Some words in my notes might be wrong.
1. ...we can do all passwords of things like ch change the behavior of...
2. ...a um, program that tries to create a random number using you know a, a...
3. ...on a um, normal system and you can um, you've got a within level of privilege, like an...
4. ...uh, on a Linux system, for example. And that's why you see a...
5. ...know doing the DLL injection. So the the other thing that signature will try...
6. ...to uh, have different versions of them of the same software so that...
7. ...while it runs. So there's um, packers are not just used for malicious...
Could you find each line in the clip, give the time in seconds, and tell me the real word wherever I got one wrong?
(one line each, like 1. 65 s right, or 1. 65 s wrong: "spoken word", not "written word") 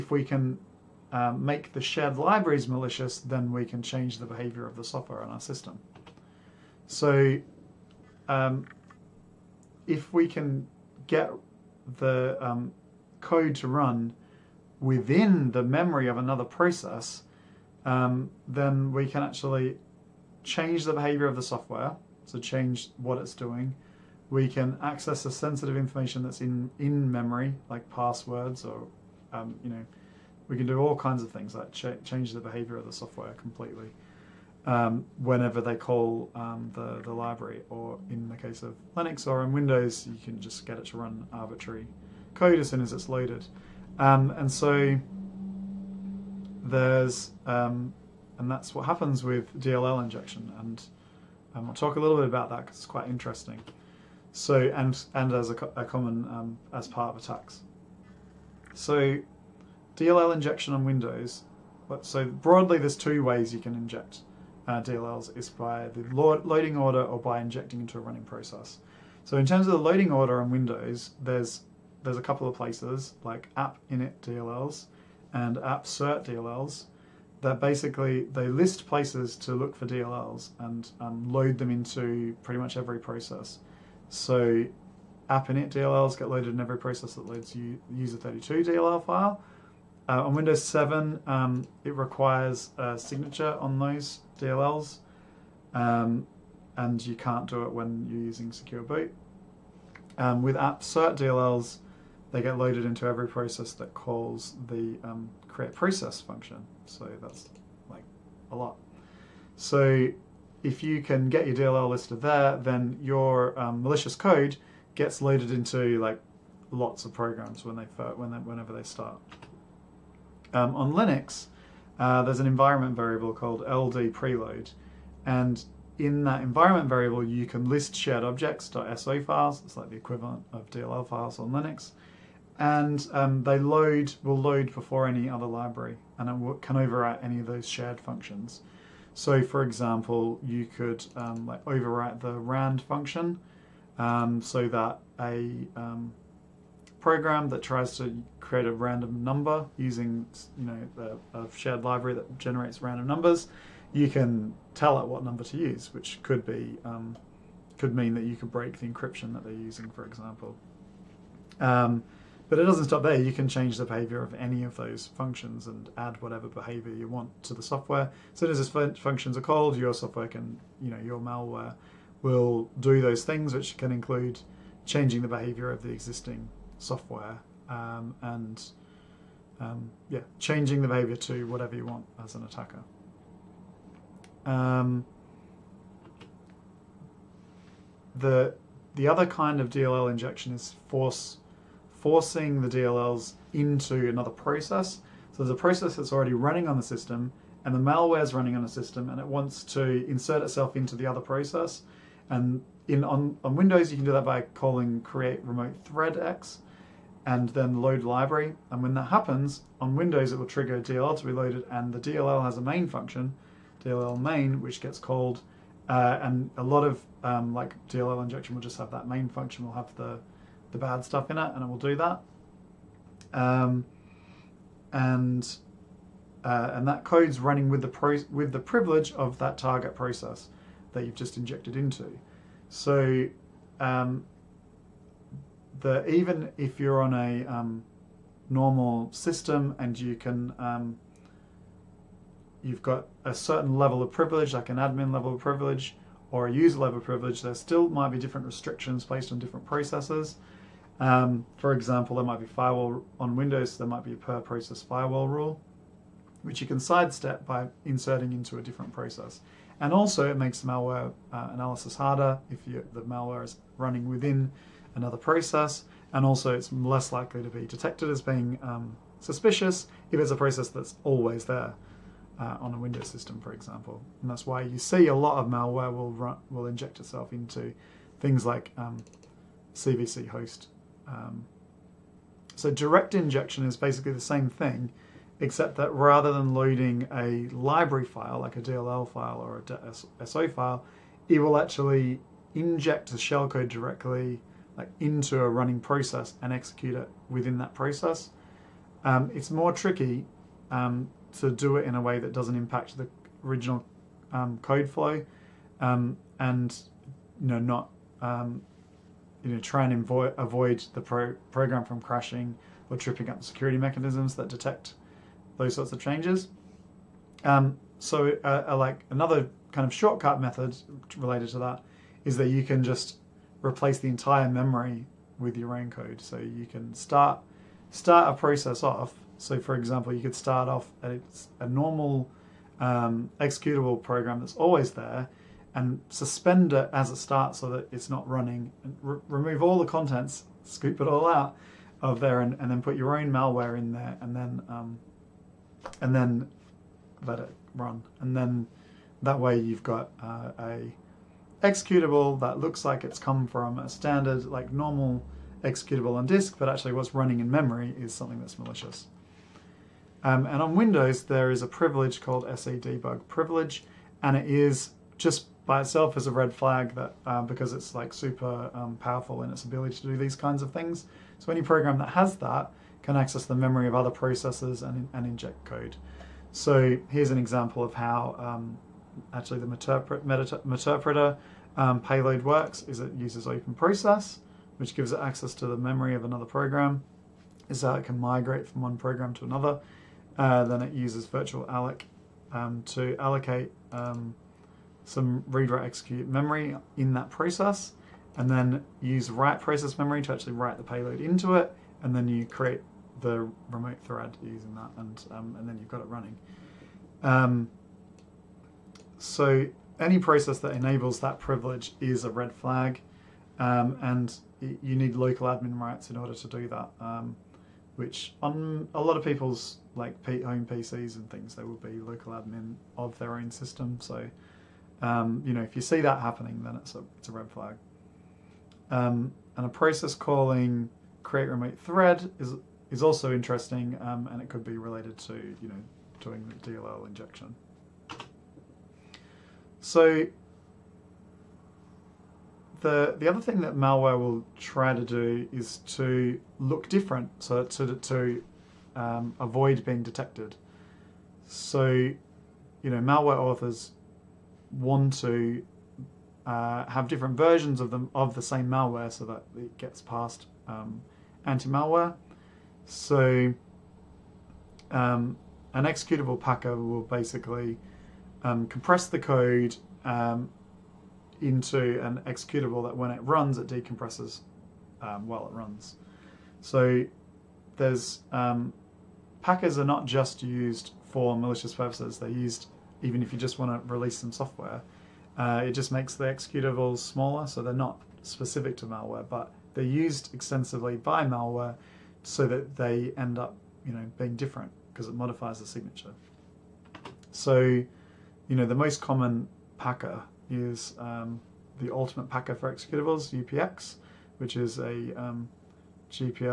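1. 30 s wrong: "kinds", not "passwords"
2. 145 s right
3. 237 s wrong: "certain", not "within"
4. 272 s wrong: "Windows", not "Linux"
5. 435 s wrong: "malware", not "signature"
6. 455 s wrong: "malware", not "software"
7. 475 s right.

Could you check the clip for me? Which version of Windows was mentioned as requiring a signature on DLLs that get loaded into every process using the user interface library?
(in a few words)
Windows 7.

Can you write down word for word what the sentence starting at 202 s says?
And in on, on Windows, you can do that by calling create remote thread x, and then load library.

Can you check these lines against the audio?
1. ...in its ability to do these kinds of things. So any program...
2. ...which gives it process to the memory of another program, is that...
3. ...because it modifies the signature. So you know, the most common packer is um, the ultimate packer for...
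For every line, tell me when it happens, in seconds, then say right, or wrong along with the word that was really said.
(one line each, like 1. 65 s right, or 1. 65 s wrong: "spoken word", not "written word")
1. 369 s right
2. 384 s wrong: "access", not "process"
3. 494 s right.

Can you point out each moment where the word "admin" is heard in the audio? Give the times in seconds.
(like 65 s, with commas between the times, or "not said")
244 s, 415 s, 422 s.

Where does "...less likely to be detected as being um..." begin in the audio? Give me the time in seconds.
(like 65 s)
266 s.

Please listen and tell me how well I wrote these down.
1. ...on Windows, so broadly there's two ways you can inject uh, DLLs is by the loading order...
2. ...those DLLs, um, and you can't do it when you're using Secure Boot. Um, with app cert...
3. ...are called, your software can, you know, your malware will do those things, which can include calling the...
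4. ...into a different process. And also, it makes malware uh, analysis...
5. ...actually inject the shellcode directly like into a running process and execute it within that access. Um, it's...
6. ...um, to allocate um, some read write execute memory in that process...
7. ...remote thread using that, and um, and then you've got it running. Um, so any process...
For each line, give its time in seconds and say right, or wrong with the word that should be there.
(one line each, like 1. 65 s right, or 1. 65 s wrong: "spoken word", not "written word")
1. 60 s right
2. 93 s right
3. 169 s wrong: "changing", not "calling"
4. 258 s right
5. 291 s wrong: "process", not "access"
6. 392 s right
7. 403 s right.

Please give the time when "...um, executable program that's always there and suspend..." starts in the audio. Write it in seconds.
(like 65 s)
332 s.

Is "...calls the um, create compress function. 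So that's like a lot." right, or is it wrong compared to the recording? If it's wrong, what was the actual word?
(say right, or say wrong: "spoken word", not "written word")
wrong: "process", not "compress".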